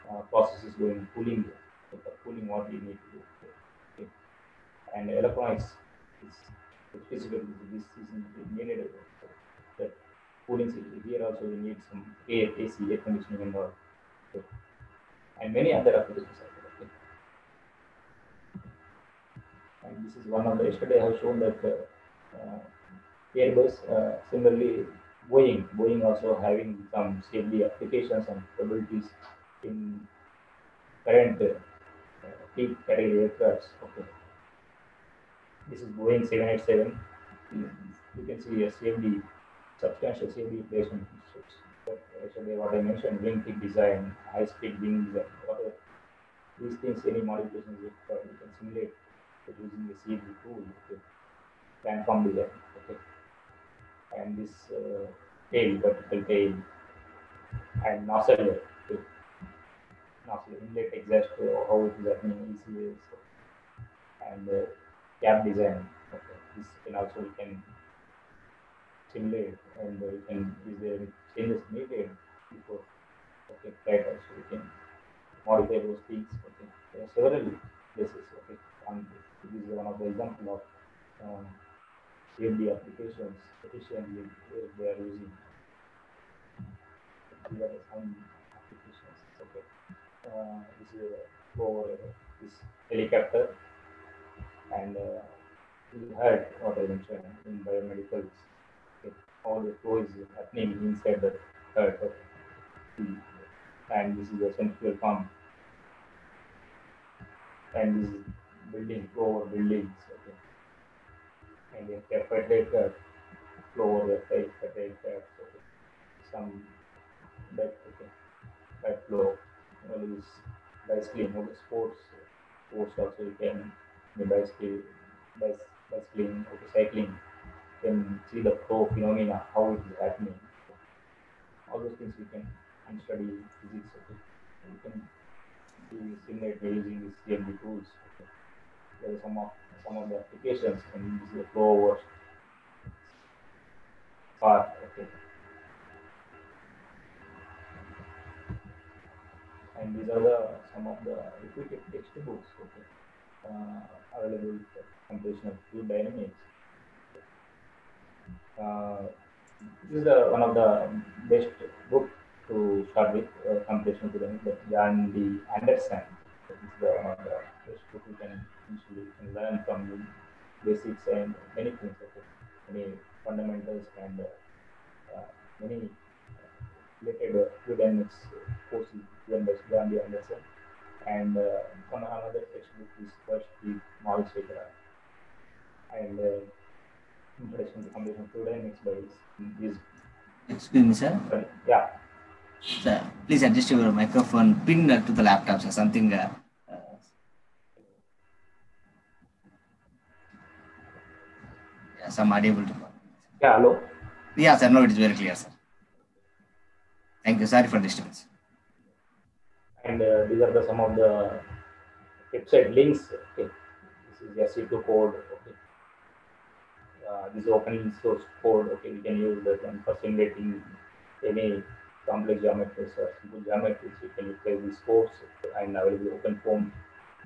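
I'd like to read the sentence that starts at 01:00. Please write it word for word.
nozzle inlet exhaust, how it is happening, easily, and uh, cap design.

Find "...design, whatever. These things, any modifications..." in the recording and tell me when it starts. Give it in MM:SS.
00:45.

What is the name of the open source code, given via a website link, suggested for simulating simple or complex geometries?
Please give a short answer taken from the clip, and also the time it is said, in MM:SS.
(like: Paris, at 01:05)
SU2, at 03:34.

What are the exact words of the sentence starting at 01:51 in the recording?
and then refrigerator flow over the refrigerator, okay.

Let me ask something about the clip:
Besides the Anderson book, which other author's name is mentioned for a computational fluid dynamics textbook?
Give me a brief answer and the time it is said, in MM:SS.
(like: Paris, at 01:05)
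Malalasekera, at 03:04.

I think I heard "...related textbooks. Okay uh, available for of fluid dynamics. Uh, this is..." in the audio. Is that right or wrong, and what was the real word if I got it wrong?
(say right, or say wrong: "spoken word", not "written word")
wrong: "repeated", not "related".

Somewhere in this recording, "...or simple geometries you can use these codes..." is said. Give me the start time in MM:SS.
03:42.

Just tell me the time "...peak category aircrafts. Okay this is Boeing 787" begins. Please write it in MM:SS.
00:32.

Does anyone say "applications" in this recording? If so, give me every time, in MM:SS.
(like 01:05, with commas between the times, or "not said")
00:15, 00:27, 01:22, 01:28, 02:20.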